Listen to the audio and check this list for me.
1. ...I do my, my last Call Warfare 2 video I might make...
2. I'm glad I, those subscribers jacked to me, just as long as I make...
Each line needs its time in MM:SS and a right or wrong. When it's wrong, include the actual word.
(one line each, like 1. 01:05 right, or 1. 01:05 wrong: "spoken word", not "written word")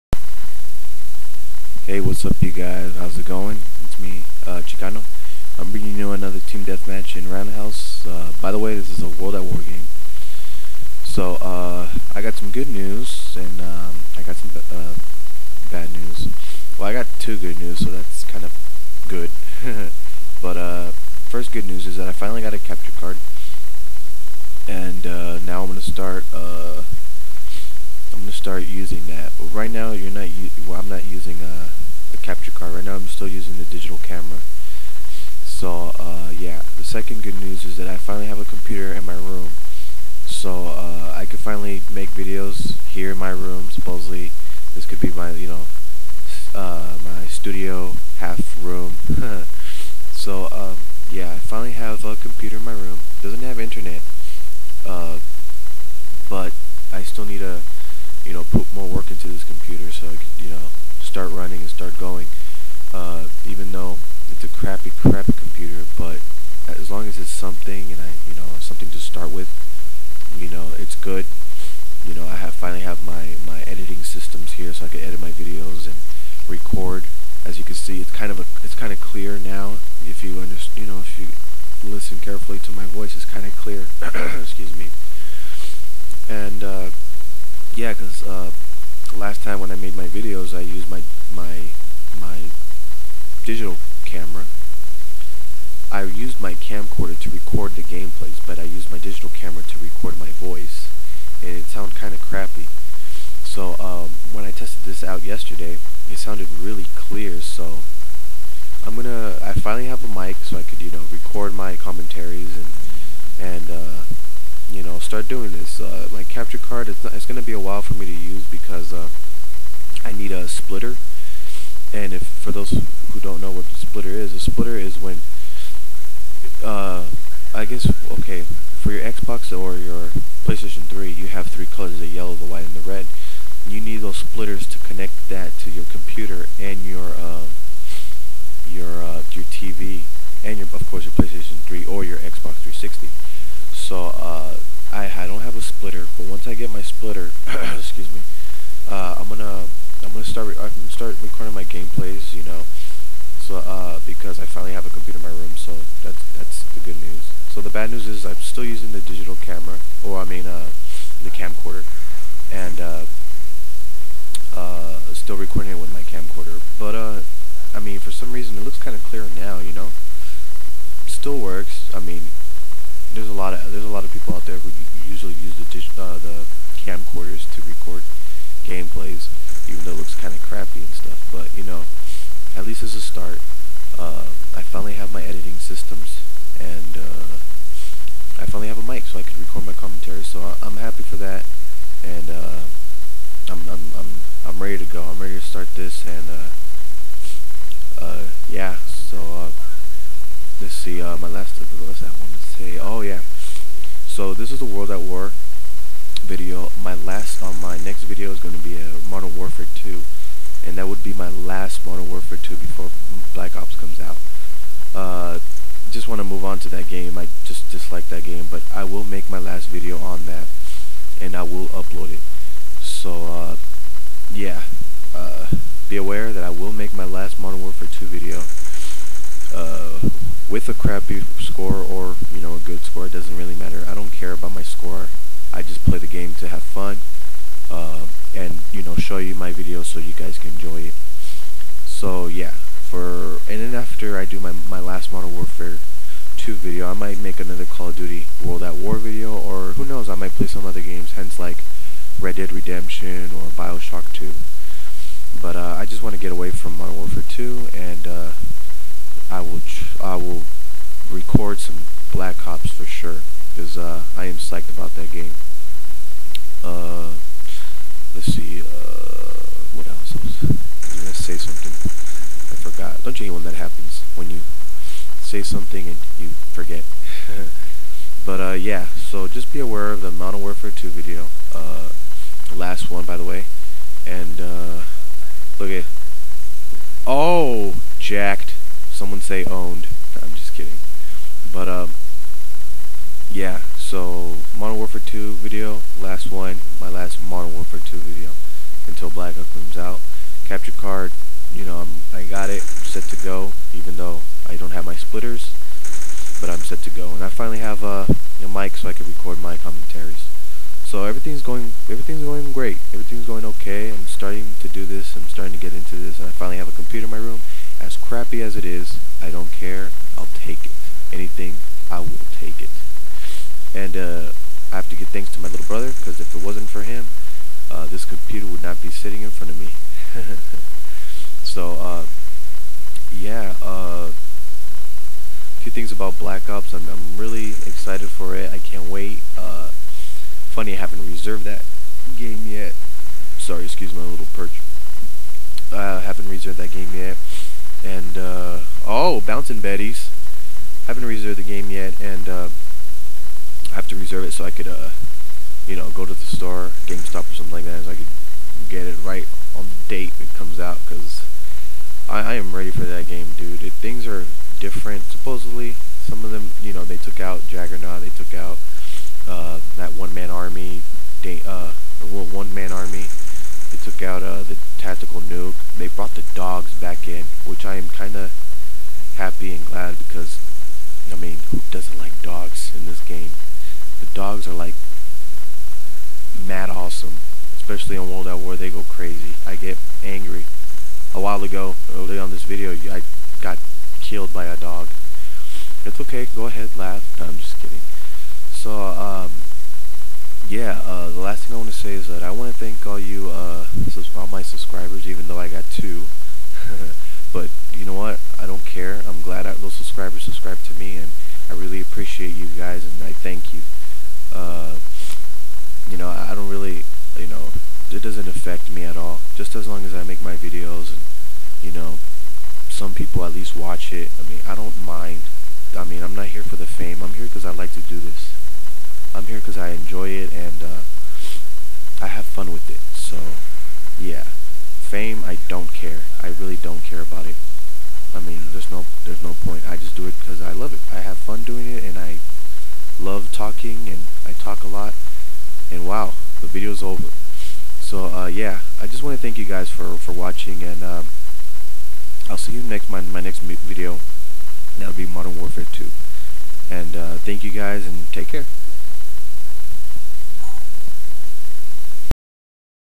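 1. 04:04 wrong: "Modern", not "Call"
2. 06:49 wrong: "subscribed", not "jacked".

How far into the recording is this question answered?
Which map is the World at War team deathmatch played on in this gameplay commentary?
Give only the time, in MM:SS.
00:07.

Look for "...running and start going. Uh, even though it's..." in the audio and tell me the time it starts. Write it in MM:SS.
01:01.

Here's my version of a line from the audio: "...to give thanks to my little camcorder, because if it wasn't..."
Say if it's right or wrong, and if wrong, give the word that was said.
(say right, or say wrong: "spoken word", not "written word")
wrong: "brother", not "camcorder".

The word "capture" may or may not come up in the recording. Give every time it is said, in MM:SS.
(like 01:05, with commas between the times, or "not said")
00:22, 00:32, 01:56, 05:00.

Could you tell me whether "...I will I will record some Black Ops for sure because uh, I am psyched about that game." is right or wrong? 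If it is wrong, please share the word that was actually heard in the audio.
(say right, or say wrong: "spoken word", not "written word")
right.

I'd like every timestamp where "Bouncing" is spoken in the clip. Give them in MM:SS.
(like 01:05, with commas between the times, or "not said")
05:49.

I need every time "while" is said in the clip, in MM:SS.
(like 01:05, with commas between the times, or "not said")
01:57, 06:31.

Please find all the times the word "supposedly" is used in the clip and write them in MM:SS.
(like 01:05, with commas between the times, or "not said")
00:43, 06:05.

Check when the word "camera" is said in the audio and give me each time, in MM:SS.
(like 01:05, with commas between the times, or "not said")
00:34, 01:34, 01:39, 02:39.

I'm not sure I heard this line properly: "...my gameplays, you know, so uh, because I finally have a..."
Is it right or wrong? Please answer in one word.
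right.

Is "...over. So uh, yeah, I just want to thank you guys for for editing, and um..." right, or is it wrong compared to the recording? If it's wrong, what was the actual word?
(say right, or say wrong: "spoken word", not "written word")
wrong: "watching", not "editing".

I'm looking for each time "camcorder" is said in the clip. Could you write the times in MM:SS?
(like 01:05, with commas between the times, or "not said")
01:36, 02:41, 02:46, 02:56.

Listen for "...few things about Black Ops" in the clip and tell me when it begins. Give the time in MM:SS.
05:35.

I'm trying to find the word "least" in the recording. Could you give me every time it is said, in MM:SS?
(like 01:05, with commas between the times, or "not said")
03:02, 07:03.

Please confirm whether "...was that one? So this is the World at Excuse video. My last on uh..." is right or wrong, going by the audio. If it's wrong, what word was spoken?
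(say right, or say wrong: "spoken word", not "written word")
wrong: "War", not "Excuse".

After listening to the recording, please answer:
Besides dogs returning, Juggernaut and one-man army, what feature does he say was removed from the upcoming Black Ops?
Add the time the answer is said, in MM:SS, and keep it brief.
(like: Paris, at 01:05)
Tactical nuke, at 06:14.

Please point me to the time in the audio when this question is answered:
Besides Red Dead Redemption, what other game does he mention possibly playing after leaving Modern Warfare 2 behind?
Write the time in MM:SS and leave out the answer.
04:13.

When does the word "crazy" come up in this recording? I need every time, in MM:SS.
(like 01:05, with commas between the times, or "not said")
06:28.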